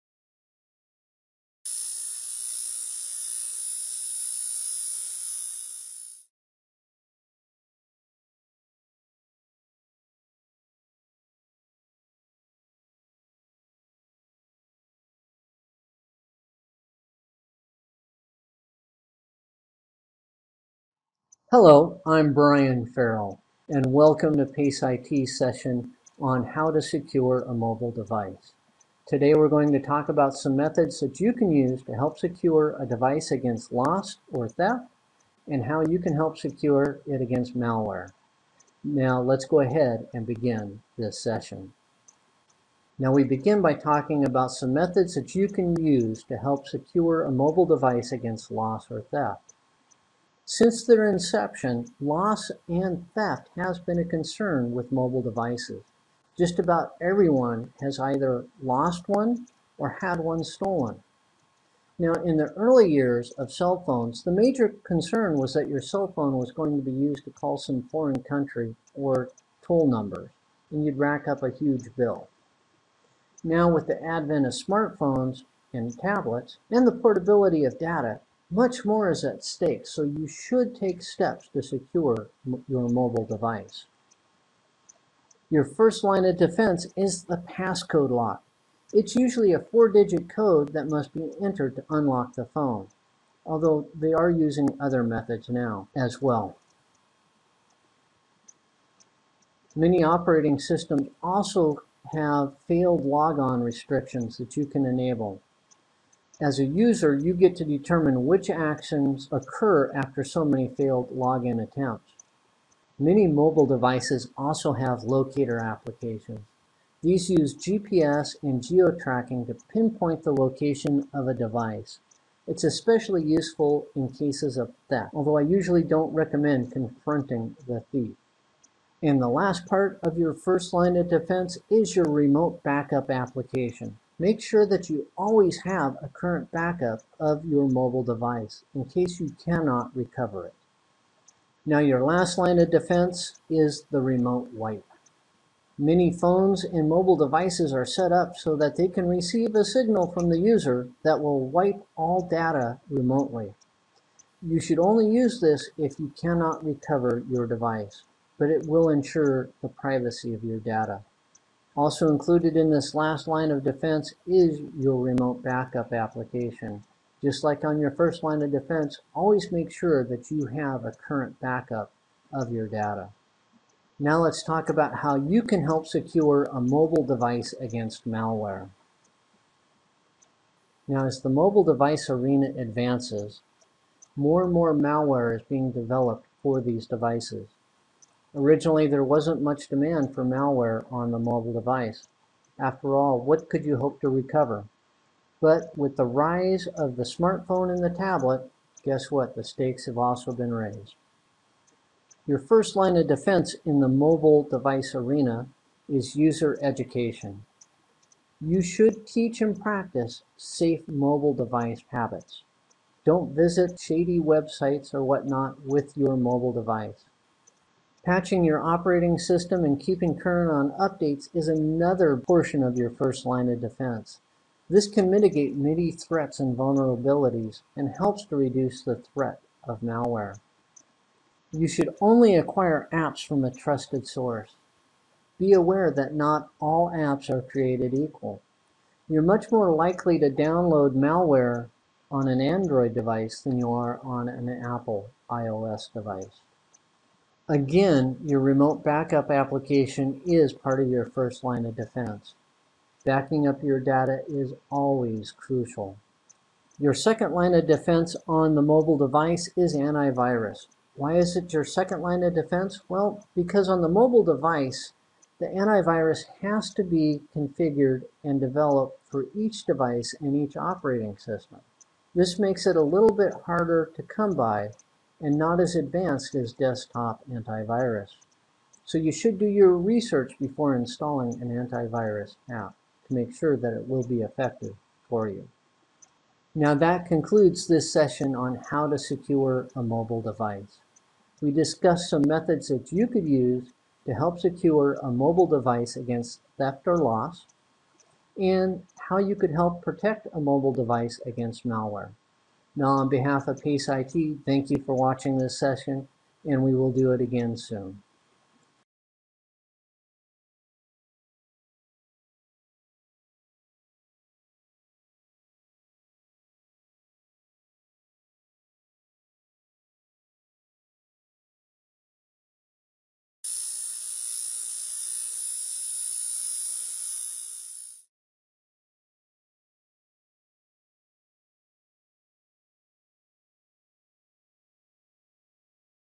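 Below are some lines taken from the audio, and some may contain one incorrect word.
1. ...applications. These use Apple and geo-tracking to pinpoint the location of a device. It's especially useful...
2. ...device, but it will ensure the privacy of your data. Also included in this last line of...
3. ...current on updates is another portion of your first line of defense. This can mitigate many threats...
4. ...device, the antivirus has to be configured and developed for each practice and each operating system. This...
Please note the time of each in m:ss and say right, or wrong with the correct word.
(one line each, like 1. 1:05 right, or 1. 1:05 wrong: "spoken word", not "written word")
1. 1:55 wrong: "GPS", not "Apple"
2. 2:37 right
3. 3:40 right
4. 4:24 wrong: "device", not "practice".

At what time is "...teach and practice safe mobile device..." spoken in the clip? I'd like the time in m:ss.
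3:29.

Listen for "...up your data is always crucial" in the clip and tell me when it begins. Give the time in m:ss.
4:13.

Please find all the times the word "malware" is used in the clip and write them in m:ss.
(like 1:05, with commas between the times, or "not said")
0:37, 2:58, 3:04, 3:10, 3:49, 4:00, 5:01.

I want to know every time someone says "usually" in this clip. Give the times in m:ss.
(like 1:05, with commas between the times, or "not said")
1:29, 2:05.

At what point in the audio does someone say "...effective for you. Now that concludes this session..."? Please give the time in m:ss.
4:44.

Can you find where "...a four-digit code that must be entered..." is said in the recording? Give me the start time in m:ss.
1:29.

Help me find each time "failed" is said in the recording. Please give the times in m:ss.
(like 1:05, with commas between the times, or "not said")
1:42, 1:50.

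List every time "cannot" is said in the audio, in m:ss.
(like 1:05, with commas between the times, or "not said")
2:19, 2:36.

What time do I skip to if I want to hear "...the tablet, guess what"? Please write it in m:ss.
3:17.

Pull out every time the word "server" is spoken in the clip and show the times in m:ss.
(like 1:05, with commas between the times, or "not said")
not said.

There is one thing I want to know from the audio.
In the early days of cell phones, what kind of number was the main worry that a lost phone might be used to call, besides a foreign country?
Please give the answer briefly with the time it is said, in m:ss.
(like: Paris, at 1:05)
toll number, at 1:09.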